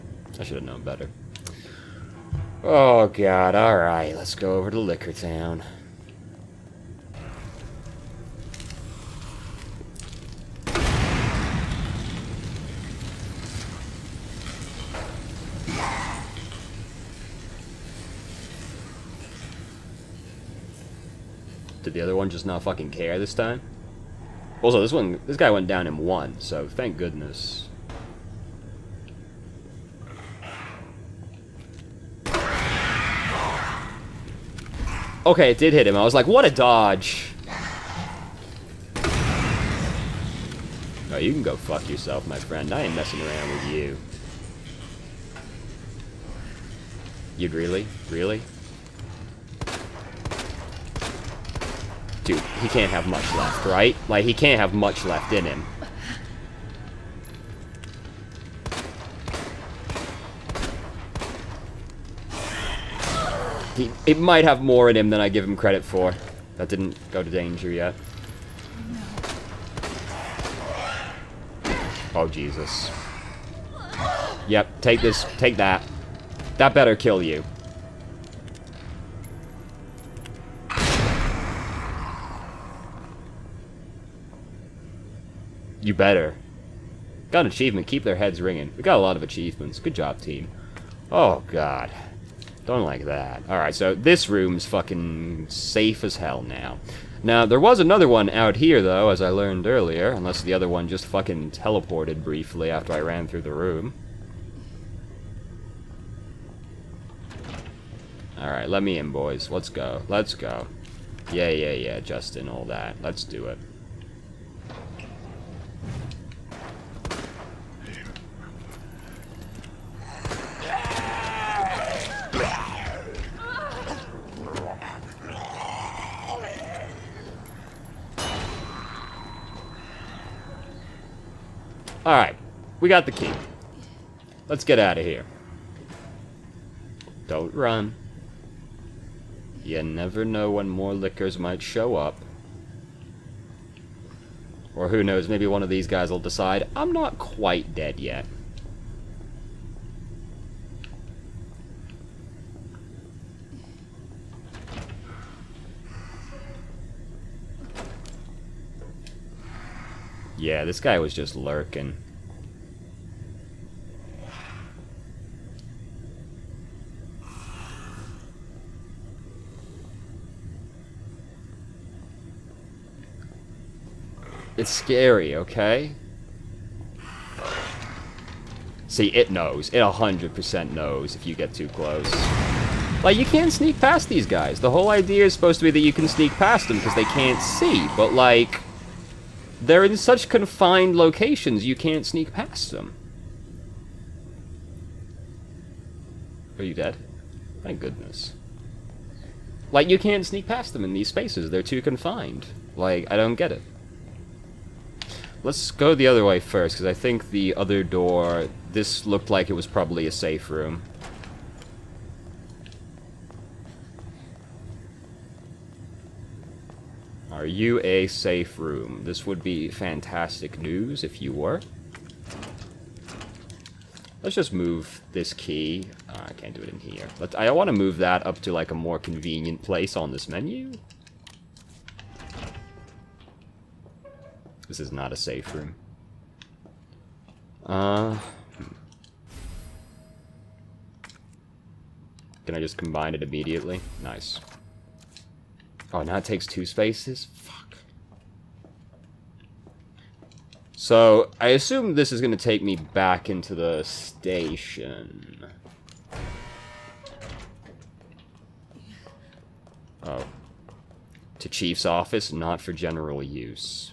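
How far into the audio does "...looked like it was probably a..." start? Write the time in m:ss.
3:29.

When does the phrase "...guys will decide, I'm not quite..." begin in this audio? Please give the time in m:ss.
2:25.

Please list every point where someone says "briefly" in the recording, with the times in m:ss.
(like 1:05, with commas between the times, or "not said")
1:42.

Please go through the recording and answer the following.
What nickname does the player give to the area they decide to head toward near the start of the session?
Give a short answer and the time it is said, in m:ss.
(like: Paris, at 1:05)
Licker Town, at 0:04.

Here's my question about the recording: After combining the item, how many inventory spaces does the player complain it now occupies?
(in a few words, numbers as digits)
2.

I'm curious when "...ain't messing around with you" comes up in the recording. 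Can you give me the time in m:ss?
0:42.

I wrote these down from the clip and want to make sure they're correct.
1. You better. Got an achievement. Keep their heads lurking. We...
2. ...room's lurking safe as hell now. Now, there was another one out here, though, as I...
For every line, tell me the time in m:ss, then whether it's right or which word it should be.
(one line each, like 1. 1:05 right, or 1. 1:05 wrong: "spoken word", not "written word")
1. 1:25 wrong: "ringing", not "lurking"
2. 1:34 wrong: "fucking", not "lurking".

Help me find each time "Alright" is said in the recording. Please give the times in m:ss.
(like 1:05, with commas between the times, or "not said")
1:33, 1:48.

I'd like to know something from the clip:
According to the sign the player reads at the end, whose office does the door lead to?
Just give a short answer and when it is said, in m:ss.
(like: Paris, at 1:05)
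Chief's office, at 4:21.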